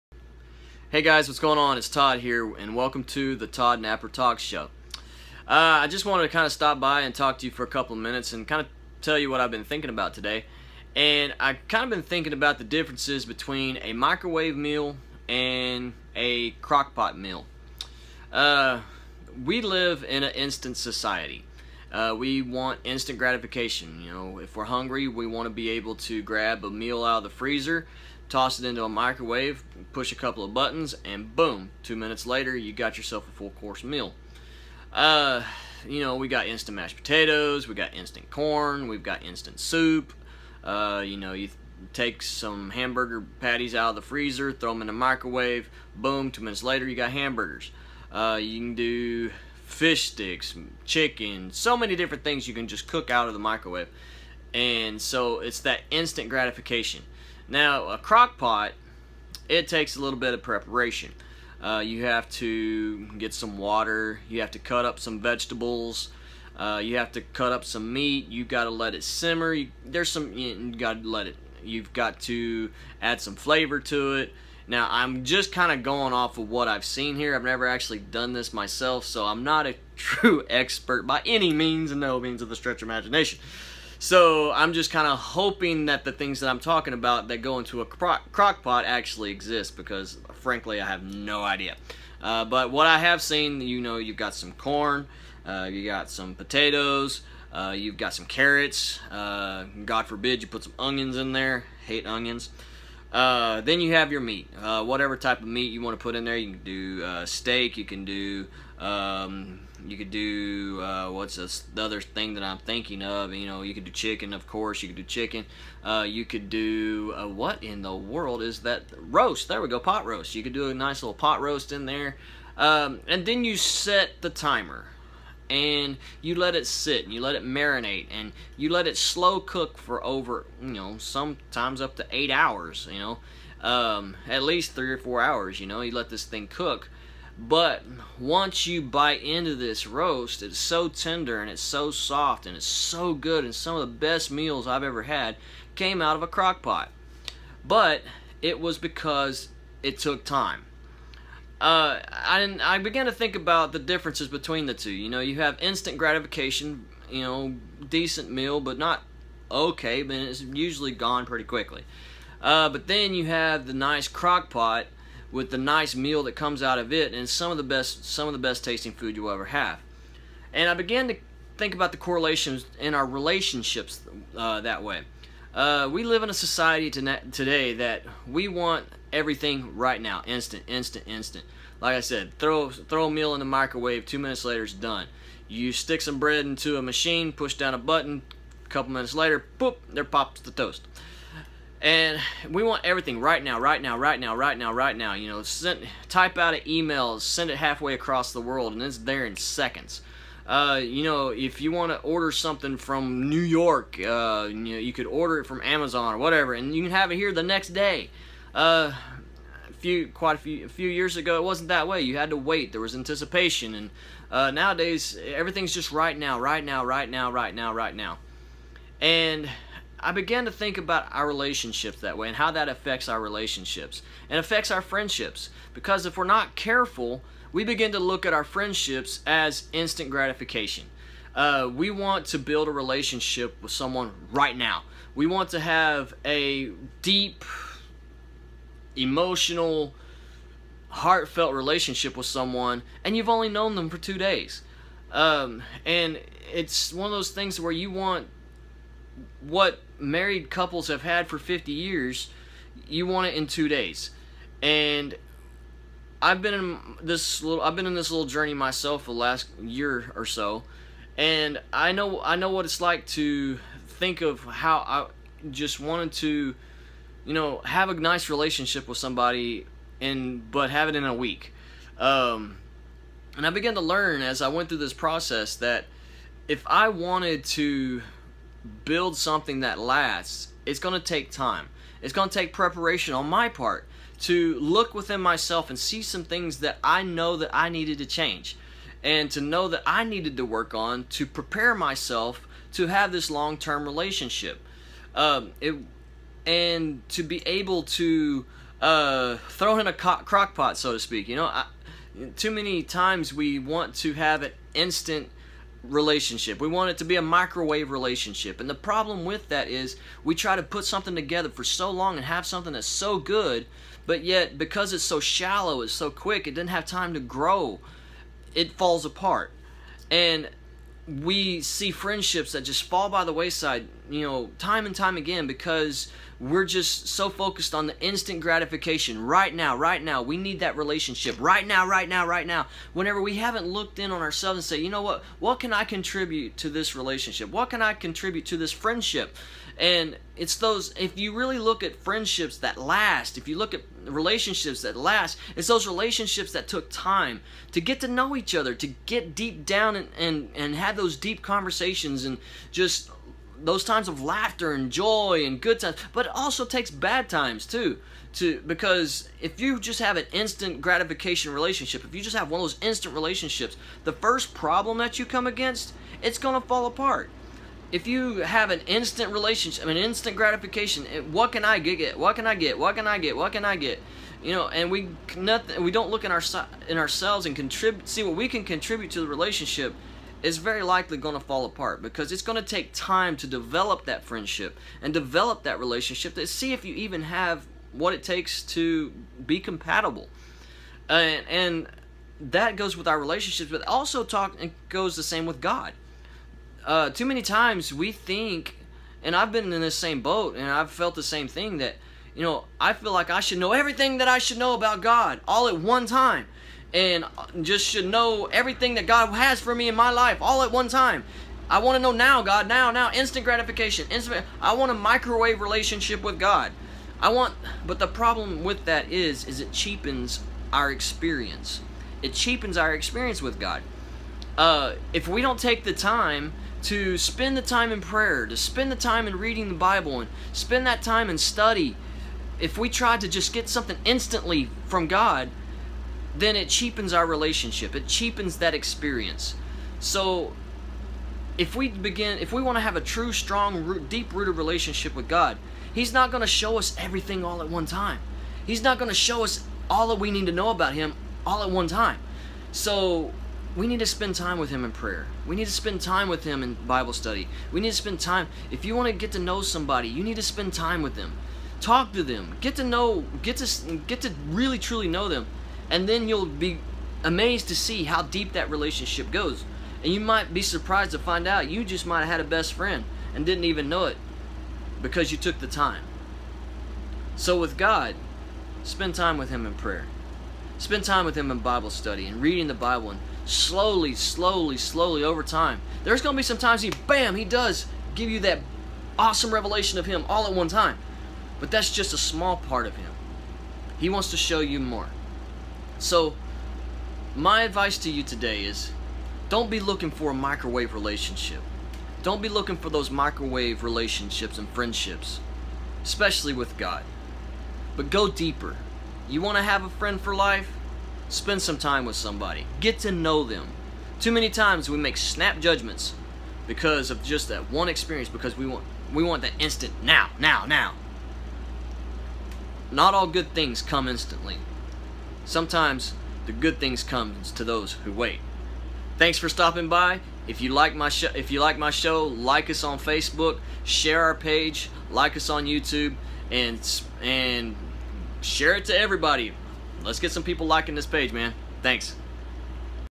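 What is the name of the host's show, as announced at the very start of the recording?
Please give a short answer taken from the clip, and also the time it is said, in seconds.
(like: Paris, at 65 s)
Todd Napper Talk Show, at 3 s.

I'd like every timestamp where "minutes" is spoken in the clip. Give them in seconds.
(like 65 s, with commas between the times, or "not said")
8 s, 31 s, 46 s, 184 s, 188 s.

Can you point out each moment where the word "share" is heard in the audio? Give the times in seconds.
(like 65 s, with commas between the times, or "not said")
533 s, 538 s.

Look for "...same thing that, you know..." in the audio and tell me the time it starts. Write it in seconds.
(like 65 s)
401 s.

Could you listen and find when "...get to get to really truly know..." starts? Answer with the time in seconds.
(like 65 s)
463 s.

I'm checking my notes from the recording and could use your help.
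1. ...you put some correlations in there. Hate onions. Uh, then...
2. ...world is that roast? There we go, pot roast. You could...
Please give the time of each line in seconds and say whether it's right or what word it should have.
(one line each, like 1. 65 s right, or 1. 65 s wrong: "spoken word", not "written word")
1. 100 s wrong: "onions", not "correlations"
2. 117 s right.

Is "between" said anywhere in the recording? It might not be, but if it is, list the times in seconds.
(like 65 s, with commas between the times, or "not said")
13 s, 154 s.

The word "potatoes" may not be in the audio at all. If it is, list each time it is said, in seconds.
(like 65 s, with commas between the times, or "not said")
36 s, 96 s.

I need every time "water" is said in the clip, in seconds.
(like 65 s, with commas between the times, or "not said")
63 s.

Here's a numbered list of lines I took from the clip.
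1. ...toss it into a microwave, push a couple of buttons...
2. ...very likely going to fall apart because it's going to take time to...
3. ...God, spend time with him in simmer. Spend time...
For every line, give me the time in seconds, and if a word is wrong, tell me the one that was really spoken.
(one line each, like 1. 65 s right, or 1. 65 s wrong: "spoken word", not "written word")
1. 28 s right
2. 380 s right
3. 477 s wrong: "prayer", not "simmer".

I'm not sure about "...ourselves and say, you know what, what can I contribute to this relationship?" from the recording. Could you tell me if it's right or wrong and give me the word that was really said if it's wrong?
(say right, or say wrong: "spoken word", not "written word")
right.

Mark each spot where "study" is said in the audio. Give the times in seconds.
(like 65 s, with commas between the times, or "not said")
431 s, 457 s, 481 s.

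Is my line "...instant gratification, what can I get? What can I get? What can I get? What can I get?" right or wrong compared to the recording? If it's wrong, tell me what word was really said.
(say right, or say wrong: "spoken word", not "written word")
right.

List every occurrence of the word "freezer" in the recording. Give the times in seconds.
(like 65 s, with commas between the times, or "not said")
27 s, 44 s.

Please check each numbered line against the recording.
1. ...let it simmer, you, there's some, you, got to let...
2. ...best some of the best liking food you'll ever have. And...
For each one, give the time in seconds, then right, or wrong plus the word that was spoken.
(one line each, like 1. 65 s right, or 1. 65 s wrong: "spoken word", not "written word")
1. 68 s right
2. 167 s wrong: "tasting", not "liking".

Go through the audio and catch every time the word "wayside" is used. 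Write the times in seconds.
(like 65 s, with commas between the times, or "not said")
323 s.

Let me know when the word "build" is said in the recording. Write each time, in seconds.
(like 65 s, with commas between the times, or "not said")
232 s, 278 s.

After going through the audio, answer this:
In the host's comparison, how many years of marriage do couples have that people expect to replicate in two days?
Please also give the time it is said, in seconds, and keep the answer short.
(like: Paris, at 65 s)
50, at 251 s.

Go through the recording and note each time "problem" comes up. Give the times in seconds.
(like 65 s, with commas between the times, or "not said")
308 s, 364 s, 418 s.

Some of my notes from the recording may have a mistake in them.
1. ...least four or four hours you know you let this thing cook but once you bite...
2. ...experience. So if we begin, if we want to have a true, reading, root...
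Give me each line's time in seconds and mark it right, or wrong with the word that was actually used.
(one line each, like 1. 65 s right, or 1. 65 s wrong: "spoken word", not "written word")
1. 134 s wrong: "three", not "four"
2. 438 s wrong: "strong", not "reading".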